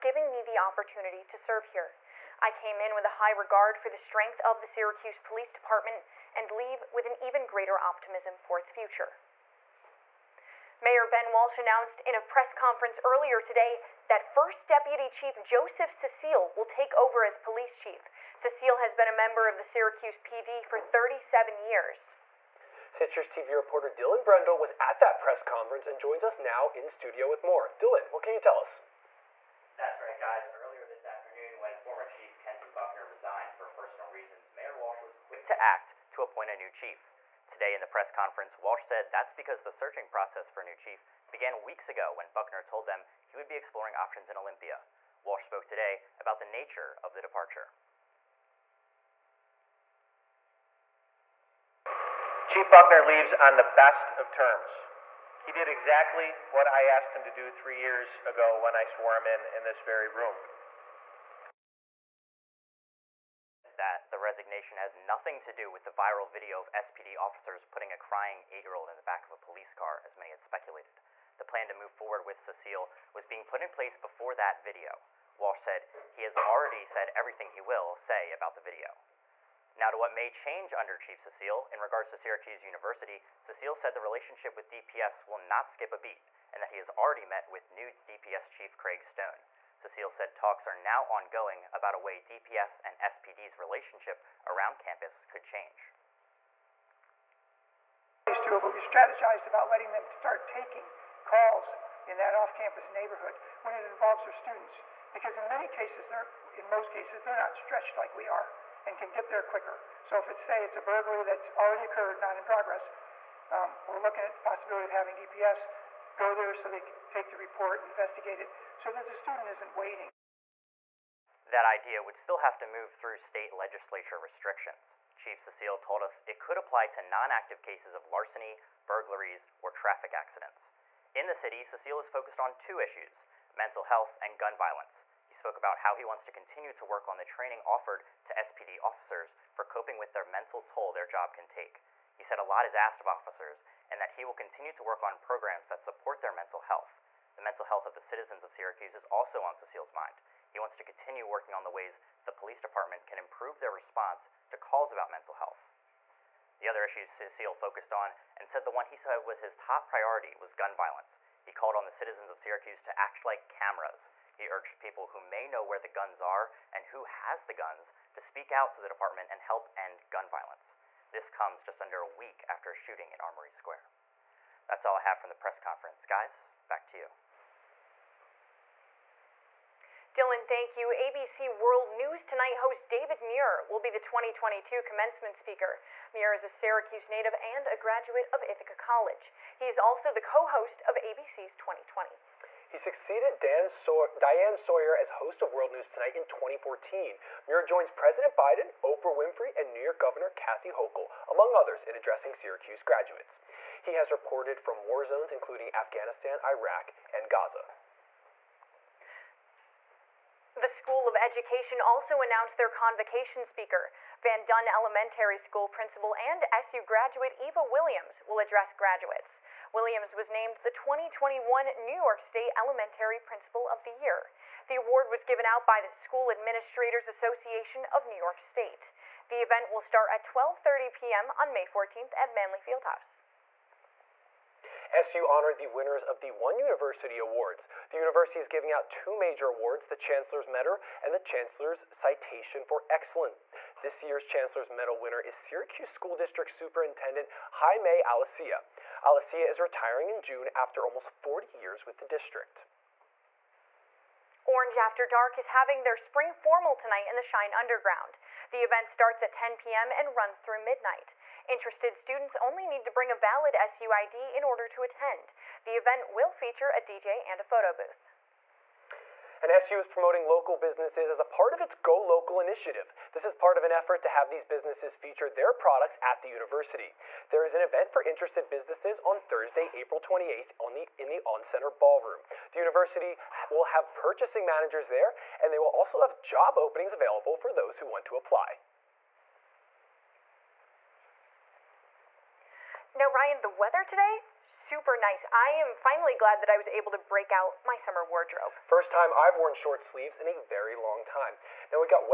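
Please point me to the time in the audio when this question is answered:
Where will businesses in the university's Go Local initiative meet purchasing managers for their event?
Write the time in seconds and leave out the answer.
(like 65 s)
281 s.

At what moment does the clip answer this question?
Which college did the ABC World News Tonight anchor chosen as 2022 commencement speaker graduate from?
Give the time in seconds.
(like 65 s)
188 s.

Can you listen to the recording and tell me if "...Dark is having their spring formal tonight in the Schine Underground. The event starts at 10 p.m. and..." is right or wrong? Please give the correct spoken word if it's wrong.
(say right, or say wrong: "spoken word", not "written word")
right.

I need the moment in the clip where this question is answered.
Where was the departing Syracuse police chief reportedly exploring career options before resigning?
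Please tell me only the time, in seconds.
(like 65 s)
44 s.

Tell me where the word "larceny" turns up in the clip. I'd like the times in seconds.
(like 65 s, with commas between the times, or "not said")
128 s.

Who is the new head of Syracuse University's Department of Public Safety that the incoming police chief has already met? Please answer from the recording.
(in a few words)
Craig Stone.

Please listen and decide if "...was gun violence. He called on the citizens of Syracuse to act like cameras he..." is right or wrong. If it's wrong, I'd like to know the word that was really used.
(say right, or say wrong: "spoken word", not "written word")
right.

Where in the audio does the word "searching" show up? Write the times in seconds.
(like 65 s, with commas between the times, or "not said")
39 s.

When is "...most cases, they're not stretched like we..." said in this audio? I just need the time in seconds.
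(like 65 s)
106 s.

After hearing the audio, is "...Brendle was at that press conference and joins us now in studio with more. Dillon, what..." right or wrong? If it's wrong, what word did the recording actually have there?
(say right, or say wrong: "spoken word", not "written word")
right.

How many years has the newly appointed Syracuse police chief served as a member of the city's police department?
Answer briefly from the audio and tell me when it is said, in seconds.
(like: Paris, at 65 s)
37, at 20 s.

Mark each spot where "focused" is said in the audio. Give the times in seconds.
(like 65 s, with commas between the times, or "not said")
132 s, 157 s.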